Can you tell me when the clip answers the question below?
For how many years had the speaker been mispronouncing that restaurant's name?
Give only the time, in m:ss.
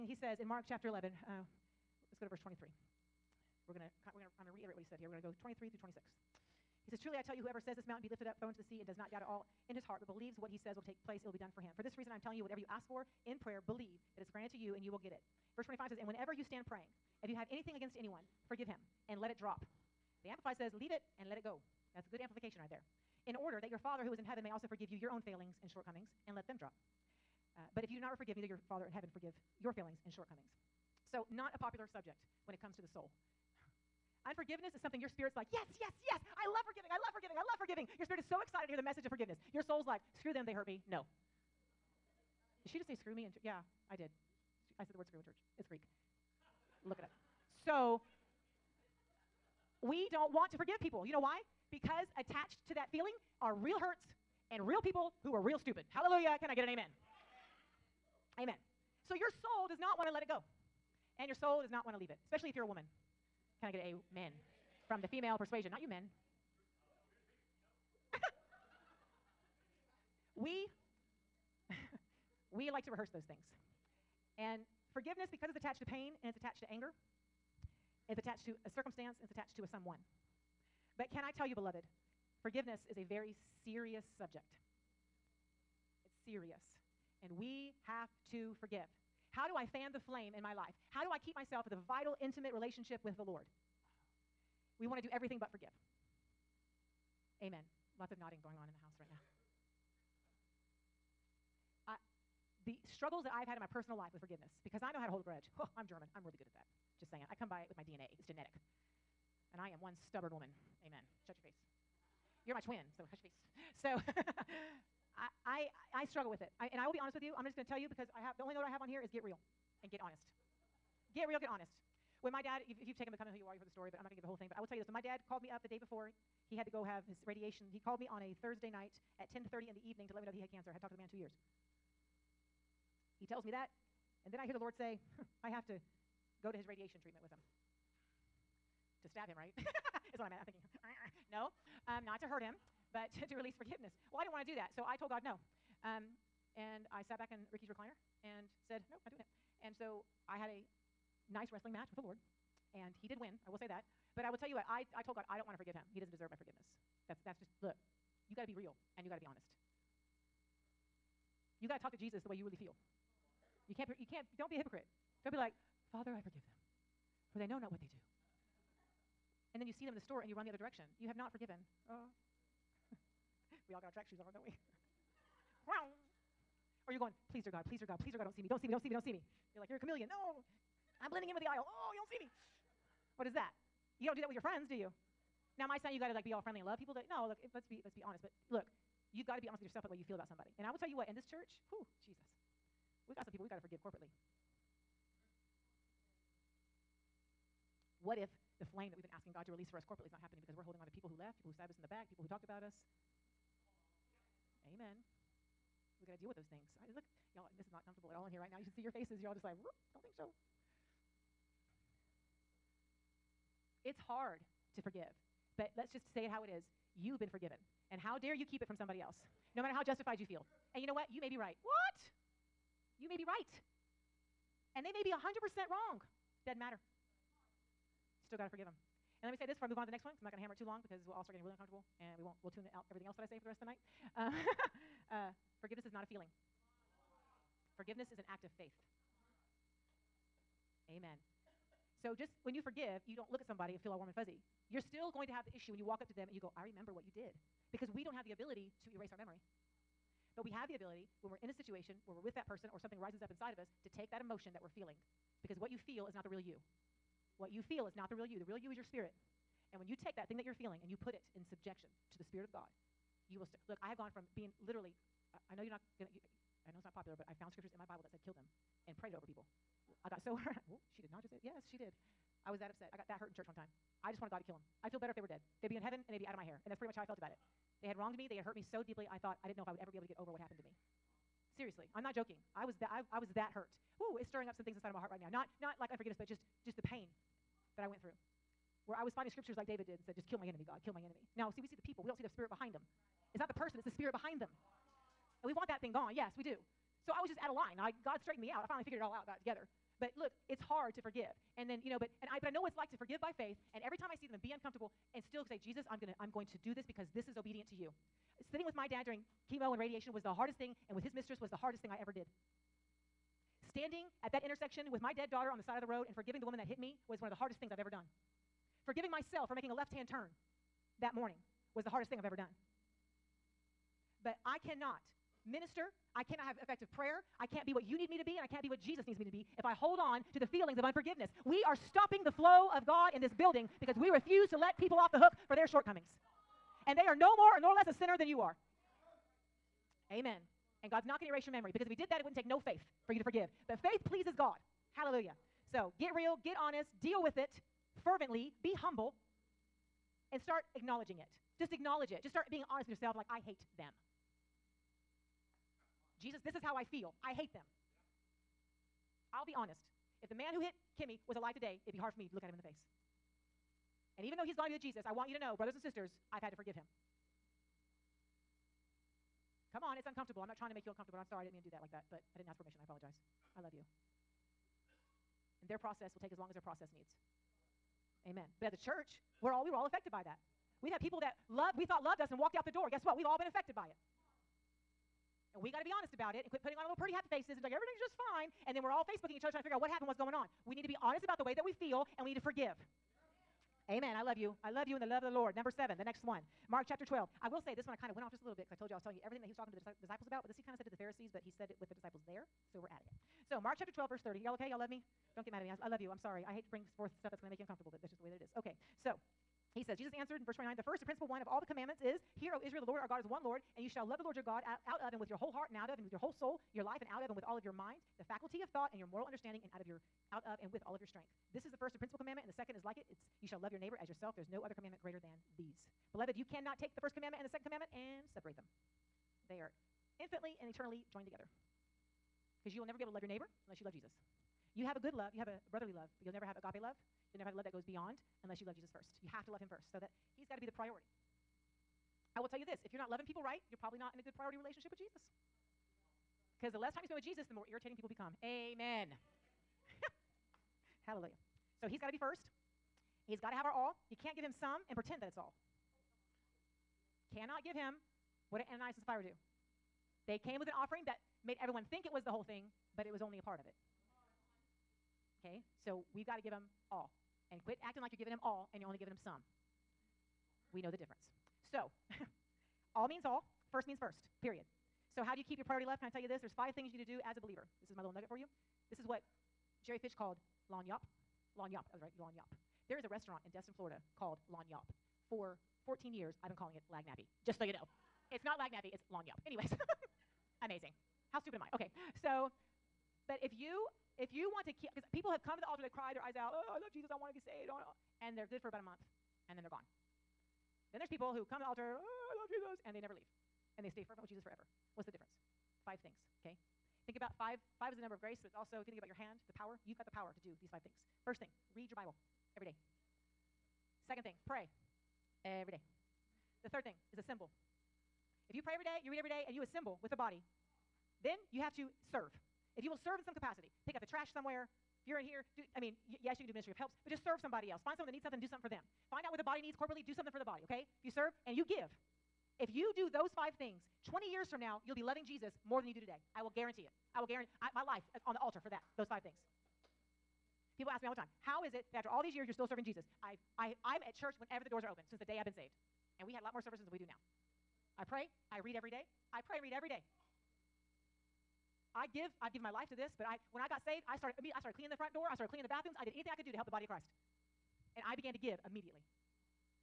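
8:05.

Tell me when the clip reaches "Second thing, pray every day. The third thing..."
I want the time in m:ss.
8:34.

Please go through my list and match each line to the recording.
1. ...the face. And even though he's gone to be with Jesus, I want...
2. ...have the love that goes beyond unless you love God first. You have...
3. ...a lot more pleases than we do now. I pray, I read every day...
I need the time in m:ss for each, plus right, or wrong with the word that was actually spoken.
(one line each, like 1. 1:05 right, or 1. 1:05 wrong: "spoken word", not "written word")
1. 6:02 right
2. 7:17 wrong: "Jesus", not "God"
3. 9:06 wrong: "services", not "pleases".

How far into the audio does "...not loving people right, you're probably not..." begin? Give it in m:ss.
7:22.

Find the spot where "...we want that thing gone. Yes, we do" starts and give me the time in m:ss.
4:55.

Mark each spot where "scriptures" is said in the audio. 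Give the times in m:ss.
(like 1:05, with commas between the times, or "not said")
4:27, 4:49.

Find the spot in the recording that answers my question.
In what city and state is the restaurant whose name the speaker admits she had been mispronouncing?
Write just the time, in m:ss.
8:03.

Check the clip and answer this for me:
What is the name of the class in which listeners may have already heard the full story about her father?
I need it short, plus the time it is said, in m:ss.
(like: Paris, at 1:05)
Becoming Who You Are, at 2:03.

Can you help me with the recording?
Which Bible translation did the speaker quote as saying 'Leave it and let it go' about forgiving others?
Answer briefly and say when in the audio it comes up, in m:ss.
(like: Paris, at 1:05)
Amplified, at 0:20.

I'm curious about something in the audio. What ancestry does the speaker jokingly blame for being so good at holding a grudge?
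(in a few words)
German.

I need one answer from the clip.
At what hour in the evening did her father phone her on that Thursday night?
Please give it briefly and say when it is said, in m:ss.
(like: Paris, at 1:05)
10:30, at 2:09.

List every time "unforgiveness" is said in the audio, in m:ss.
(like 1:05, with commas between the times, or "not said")
0:34, 4:45, 5:30.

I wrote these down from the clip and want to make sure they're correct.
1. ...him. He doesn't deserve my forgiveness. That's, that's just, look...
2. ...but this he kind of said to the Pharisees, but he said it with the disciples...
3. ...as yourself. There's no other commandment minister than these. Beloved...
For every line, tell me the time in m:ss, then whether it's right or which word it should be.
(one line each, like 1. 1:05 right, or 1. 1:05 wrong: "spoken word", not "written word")
1. 2:35 right
2. 6:40 right
3. 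7:04 wrong: "greater", not "minister".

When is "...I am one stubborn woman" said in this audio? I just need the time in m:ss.
1:49.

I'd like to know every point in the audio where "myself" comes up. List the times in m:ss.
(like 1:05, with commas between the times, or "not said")
1:31, 5:19.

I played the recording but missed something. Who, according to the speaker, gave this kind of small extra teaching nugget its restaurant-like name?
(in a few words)
Jerry Fish.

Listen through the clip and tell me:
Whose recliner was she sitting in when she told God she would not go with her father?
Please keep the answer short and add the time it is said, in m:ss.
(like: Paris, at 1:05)
Ricky's, at 2:27.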